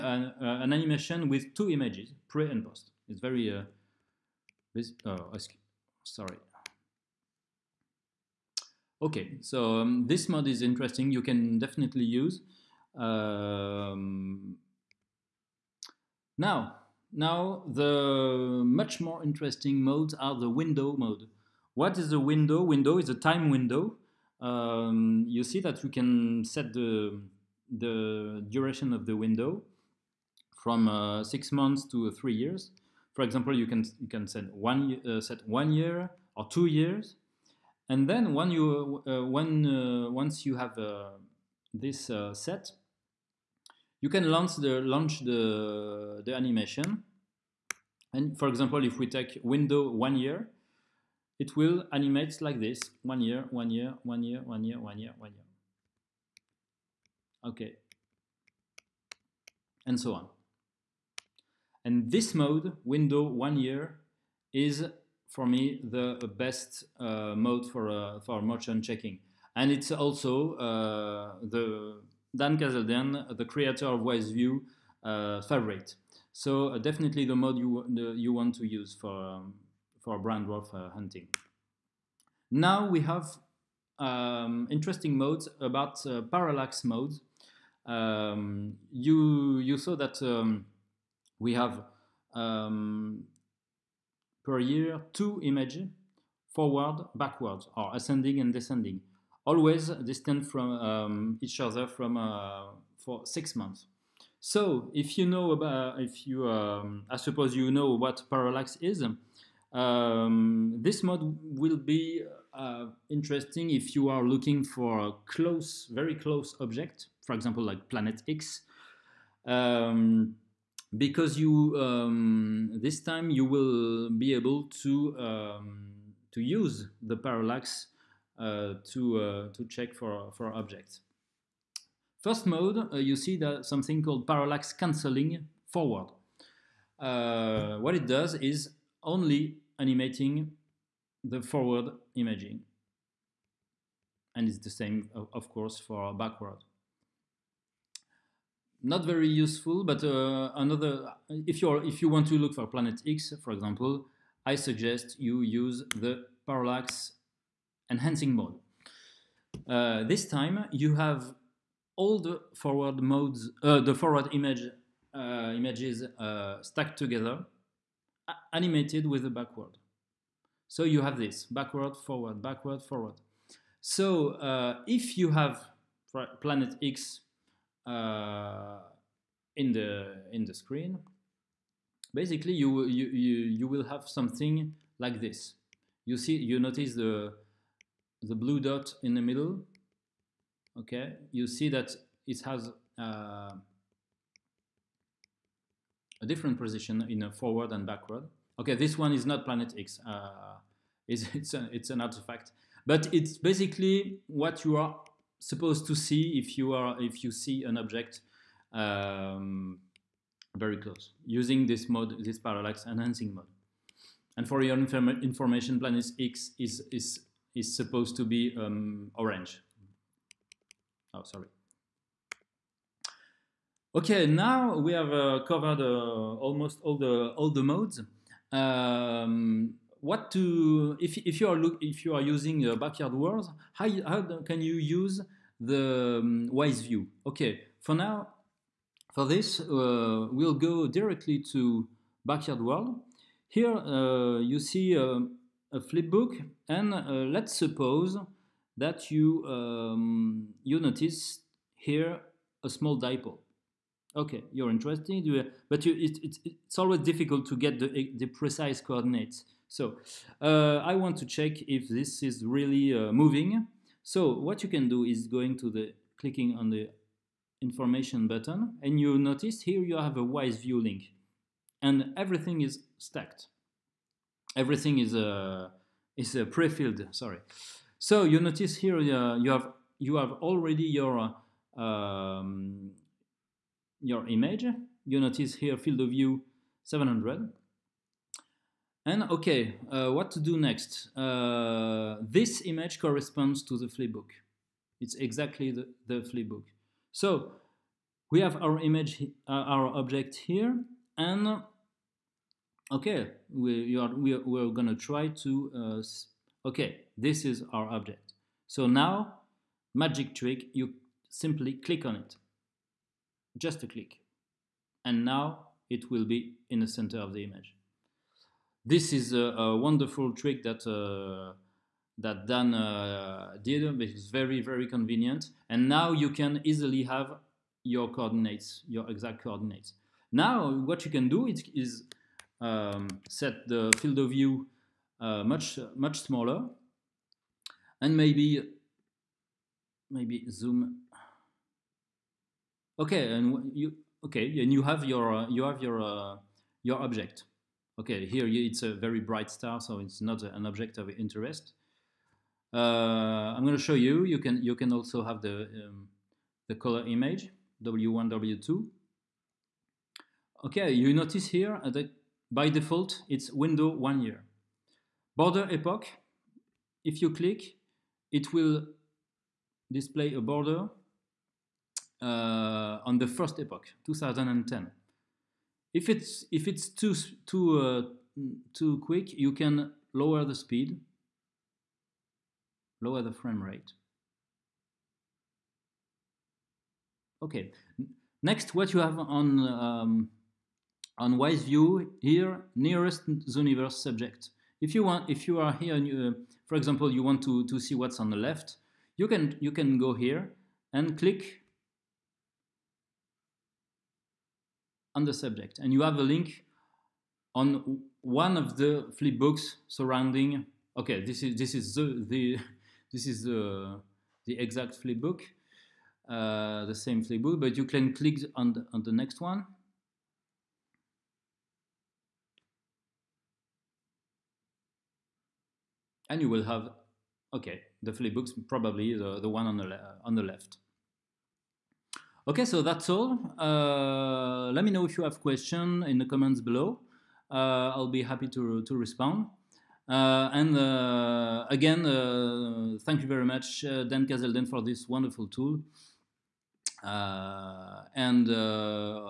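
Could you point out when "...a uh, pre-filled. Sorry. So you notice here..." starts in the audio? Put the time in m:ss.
4:36.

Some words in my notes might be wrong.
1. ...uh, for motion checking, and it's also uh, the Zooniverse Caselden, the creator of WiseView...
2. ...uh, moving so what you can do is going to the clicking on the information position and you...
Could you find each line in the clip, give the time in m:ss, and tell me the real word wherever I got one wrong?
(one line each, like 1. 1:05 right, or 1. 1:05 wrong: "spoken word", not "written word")
1. 1:07 wrong: "Dan", not "Zooniverse"
2. 4:22 wrong: "button", not "position".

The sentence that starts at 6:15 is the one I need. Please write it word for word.
If it's, if it's too, too, uh, too quick, you can lower the speed, lower the frame rate.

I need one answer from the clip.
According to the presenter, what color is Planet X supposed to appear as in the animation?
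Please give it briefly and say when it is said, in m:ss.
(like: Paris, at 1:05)
Orange, at 3:39.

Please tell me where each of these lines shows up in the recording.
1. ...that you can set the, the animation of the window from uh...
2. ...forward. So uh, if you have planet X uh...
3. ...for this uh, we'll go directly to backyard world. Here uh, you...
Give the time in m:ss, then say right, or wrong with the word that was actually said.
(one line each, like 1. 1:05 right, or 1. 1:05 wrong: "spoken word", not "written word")
1. 0:25 wrong: "duration", not "animation"
2. 2:52 right
3. 3:59 right.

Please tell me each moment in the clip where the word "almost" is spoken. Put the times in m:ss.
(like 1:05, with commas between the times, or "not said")
3:46.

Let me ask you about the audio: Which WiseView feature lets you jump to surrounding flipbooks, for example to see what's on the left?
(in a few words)
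Nearest Zooniverse subject.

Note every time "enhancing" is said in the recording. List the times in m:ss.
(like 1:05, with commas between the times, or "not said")
2:37, 3:32.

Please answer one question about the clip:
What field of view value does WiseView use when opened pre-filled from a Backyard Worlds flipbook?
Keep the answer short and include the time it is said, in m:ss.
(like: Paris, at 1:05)
700, at 4:46.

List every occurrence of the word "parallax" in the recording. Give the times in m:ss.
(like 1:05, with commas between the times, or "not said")
1:26, 1:48, 2:07, 2:14, 2:36, 3:32.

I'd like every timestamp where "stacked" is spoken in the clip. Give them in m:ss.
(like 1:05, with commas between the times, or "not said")
2:46, 4:32.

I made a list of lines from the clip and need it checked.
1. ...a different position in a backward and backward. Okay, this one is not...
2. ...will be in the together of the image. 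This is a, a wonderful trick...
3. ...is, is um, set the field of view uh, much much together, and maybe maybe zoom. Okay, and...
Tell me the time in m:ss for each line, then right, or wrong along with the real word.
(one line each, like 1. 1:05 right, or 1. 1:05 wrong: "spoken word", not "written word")
1. 3:16 wrong: "forward", not "backward"
2. 5:16 wrong: "center", not "together"
3. 5:31 wrong: "smaller", not "together".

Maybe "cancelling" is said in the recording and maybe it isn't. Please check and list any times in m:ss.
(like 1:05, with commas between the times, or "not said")
2:14.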